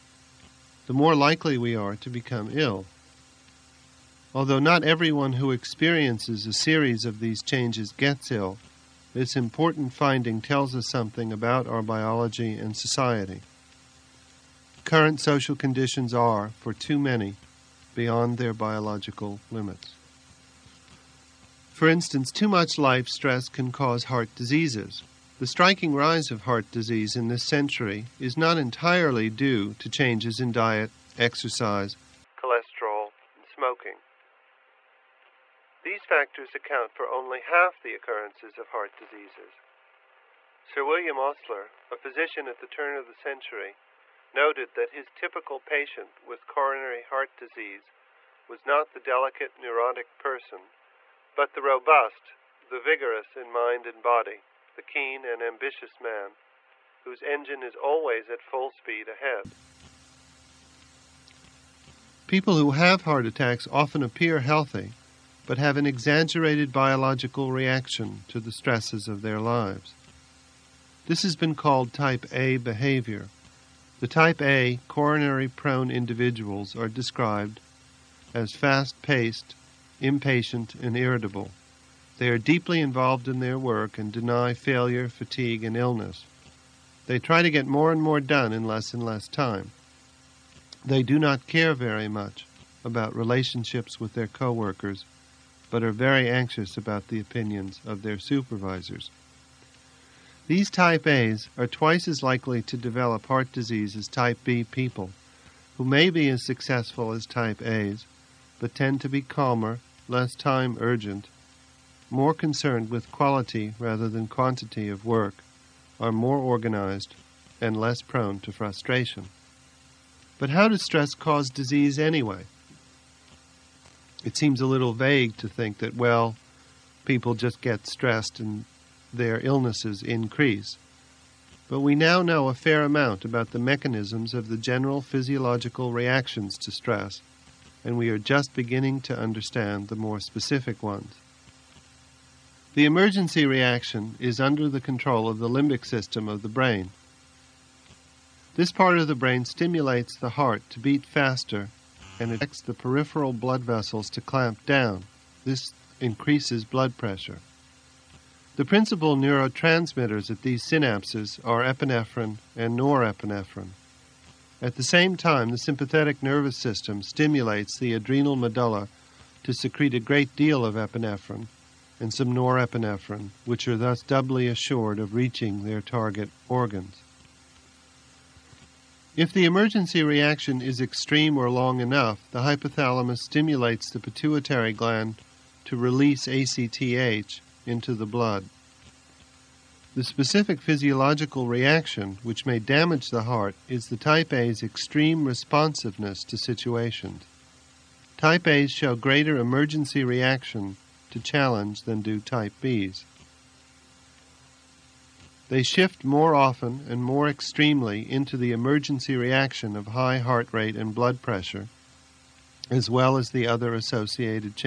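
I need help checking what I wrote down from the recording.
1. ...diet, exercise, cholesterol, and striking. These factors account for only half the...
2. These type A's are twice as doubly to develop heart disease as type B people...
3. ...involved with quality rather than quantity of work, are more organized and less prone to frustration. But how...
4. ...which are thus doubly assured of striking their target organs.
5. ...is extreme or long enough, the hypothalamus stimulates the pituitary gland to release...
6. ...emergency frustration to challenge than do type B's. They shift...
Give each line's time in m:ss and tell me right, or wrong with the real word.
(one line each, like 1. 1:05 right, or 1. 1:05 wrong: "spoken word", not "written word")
1. 0:30 wrong: "smoking", not "striking"
2. 1:40 wrong: "likely", not "doubly"
3. 1:52 wrong: "concerned", not "involved"
4. 2:53 wrong: "reaching", not "striking"
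5. 3:00 right
6. 3:19 wrong: "reaction", not "frustration".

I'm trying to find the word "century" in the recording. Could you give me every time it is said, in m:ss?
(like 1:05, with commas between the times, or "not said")
0:27, 0:43.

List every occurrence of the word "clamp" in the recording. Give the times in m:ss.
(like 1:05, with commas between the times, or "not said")
2:34.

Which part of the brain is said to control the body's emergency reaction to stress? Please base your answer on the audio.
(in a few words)
limbic system.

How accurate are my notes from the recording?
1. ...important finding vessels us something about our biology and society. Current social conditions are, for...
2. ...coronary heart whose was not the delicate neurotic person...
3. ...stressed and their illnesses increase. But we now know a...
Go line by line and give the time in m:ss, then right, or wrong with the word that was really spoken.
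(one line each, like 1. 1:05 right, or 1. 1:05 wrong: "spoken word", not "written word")
1. 0:09 wrong: "tells", not "vessels"
2. 0:46 wrong: "disease", not "whose"
3. 2:07 right.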